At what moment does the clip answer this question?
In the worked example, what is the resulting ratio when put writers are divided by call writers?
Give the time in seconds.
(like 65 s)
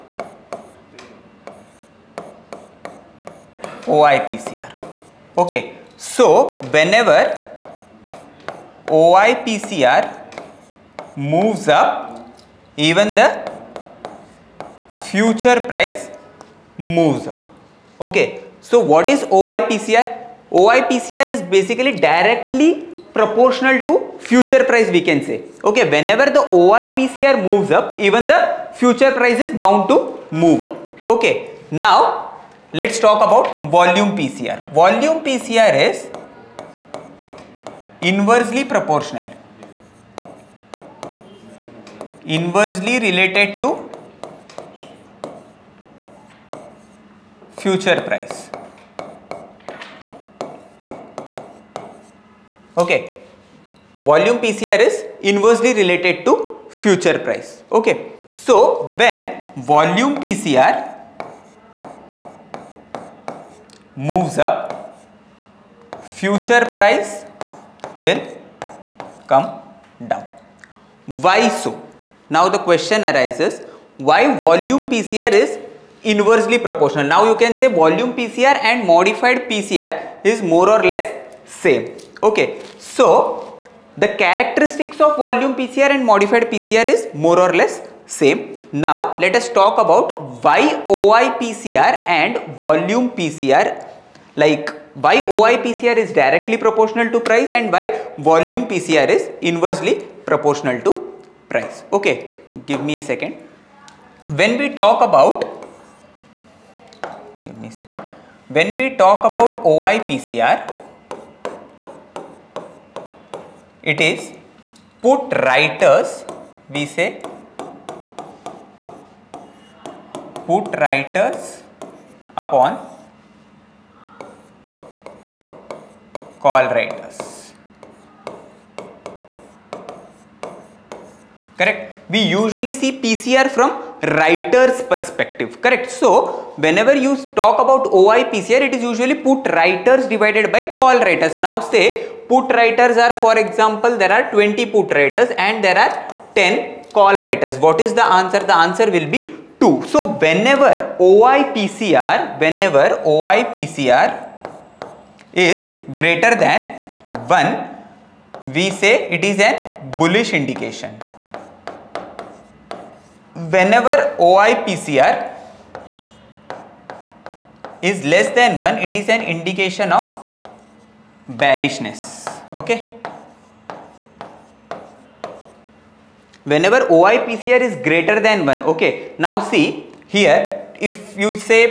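149 s.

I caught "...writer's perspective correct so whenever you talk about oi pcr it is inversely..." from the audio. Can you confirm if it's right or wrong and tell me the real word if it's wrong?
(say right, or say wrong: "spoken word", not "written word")
wrong: "usually", not "inversely".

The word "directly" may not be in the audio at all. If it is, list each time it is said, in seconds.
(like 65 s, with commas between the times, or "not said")
21 s, 96 s.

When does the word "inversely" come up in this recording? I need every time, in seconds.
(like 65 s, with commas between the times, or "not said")
38 s, 42 s, 55 s, 76 s, 99 s.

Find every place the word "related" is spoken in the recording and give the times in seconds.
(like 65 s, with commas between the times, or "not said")
43 s, 55 s.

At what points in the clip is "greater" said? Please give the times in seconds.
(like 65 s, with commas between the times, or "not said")
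156 s, 177 s.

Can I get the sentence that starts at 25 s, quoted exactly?
Okay, whenever the OIPCR moves up, even the future price is bound to move up.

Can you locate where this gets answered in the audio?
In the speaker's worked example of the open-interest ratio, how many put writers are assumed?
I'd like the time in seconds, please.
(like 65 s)
144 s.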